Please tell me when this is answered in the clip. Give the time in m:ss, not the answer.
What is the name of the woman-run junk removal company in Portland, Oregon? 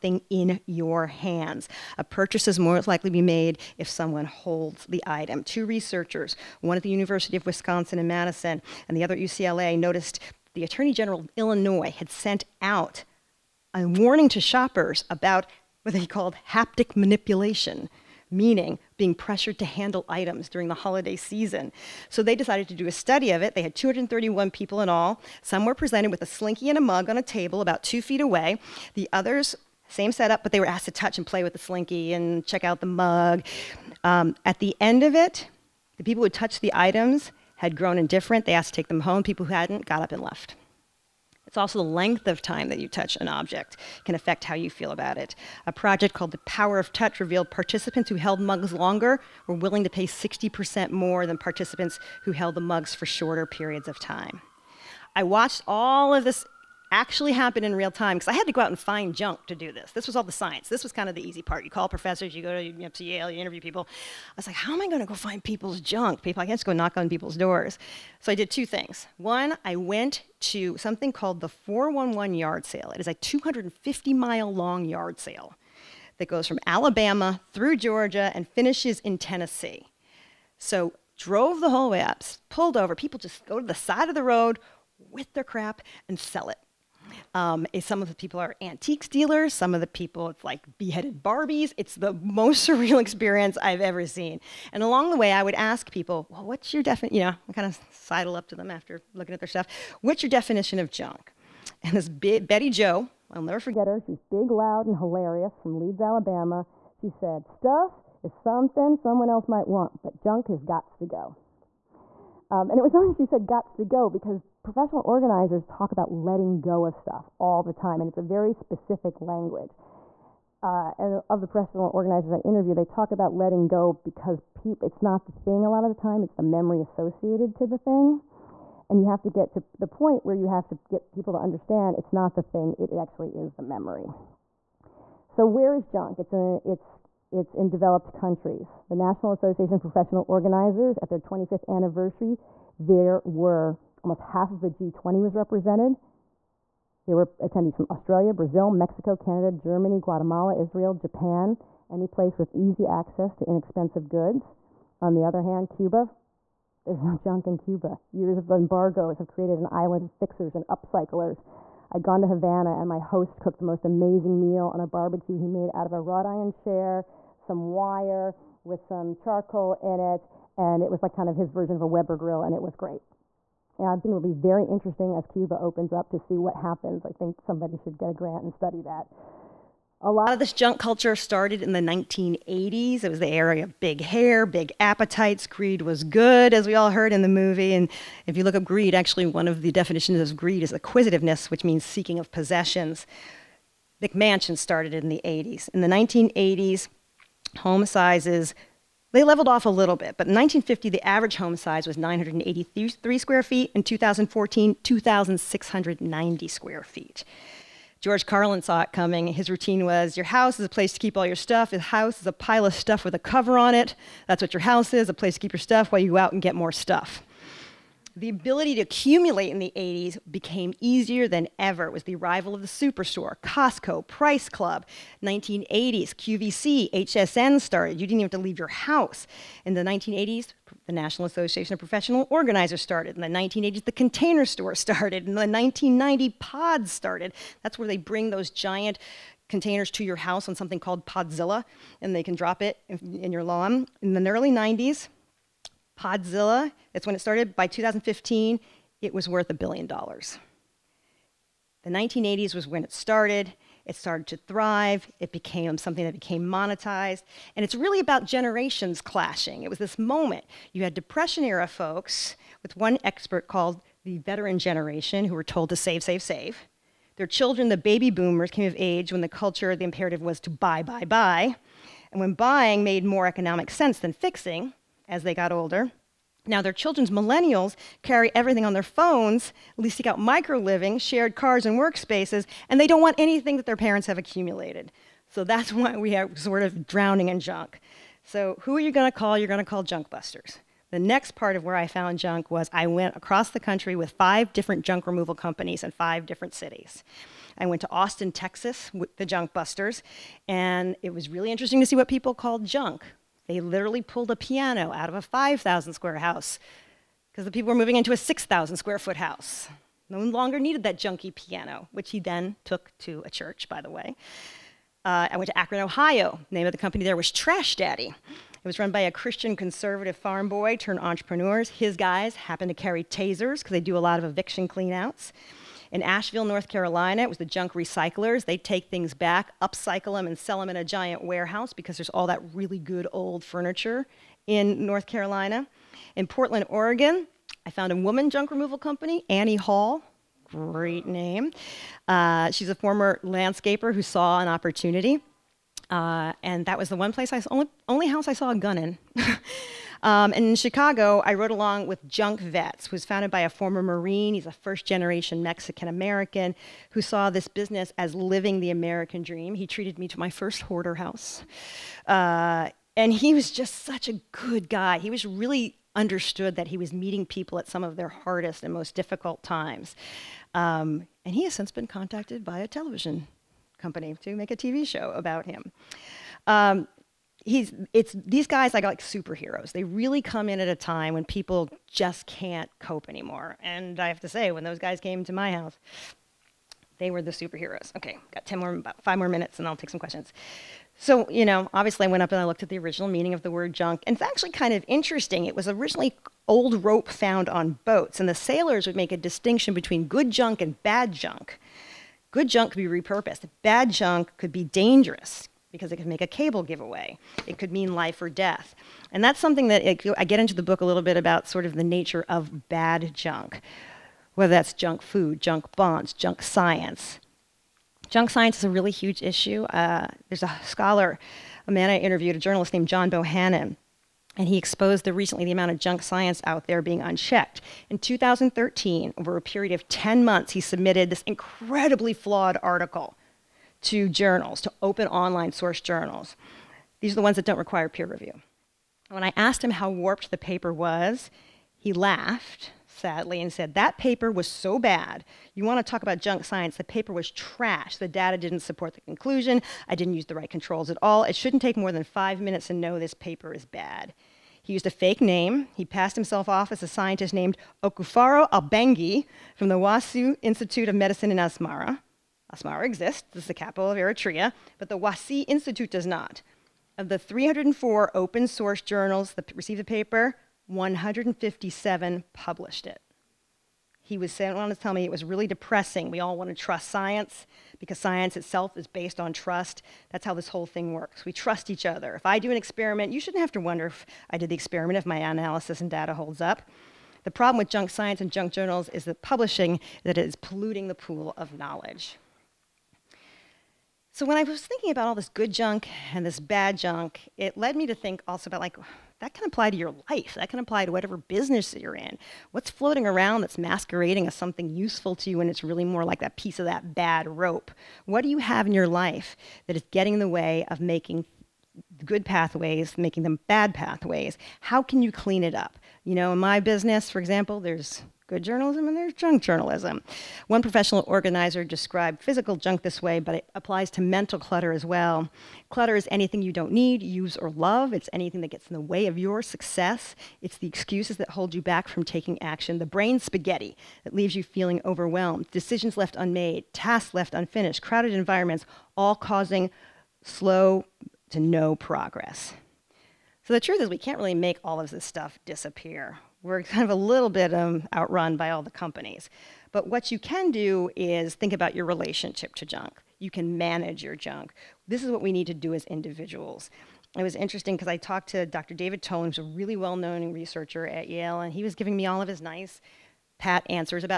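5:39.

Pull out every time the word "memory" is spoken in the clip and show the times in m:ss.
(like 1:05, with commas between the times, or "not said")
2:06, 2:13.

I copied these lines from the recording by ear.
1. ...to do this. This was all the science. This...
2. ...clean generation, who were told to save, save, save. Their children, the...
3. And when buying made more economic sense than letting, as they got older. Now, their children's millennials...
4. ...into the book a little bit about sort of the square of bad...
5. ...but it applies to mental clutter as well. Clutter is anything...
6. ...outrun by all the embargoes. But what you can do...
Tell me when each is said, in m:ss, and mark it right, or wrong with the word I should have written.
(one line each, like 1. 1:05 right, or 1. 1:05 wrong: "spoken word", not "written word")
1. 0:59 right
2. 4:24 wrong: "veteran", not "clean"
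3. 4:32 wrong: "fixing", not "letting"
4. 6:50 wrong: "nature", not "square"
5. 8:43 right
6. 9:07 wrong: "companies", not "embargoes".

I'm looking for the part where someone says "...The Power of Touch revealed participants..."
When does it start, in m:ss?
0:46.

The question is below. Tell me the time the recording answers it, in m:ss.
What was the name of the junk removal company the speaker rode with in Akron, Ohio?
5:17.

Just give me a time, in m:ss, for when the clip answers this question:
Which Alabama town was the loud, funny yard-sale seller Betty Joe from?
1:45.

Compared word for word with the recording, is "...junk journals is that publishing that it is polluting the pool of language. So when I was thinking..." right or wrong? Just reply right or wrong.
wrong.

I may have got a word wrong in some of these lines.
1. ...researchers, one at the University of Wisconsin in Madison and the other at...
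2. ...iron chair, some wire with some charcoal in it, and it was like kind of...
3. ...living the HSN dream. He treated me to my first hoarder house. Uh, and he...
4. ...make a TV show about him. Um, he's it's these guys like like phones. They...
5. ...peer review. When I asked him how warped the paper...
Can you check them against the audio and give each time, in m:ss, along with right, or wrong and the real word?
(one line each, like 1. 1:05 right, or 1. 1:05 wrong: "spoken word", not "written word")
1. 0:05 right
2. 2:46 right
3. 5:58 wrong: "American", not "HSN"
4. 6:14 wrong: "superheroes", not "phones"
5. 7:17 right.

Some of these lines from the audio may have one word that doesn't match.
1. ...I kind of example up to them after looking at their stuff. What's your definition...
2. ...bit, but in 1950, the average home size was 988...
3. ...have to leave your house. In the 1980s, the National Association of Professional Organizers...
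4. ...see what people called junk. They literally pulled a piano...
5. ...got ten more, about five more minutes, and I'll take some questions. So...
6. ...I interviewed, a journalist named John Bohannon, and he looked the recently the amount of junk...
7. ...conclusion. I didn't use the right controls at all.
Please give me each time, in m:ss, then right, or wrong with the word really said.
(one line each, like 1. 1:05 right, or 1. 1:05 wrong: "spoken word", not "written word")
1. 1:37 wrong: "sidle", not "example"
2. 3:19 wrong: "983", not "988"
3. 3:48 right
4. 5:01 right
5. 6:28 right
6. 7:01 wrong: "exposed", not "looked"
7. 7:29 right.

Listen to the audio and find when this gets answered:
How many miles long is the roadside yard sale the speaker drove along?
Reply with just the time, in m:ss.
1:13.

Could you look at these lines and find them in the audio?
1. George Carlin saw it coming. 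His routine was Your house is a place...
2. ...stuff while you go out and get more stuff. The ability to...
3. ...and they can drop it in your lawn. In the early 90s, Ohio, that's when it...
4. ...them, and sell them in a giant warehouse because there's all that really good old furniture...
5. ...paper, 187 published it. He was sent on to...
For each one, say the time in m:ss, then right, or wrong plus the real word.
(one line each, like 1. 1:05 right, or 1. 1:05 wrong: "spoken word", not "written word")
1. 3:28 right
2. 3:35 right
3. 4:02 wrong: "Podzilla", not "Ohio"
4. 5:30 right
5. 7:49 wrong: "157", not "187".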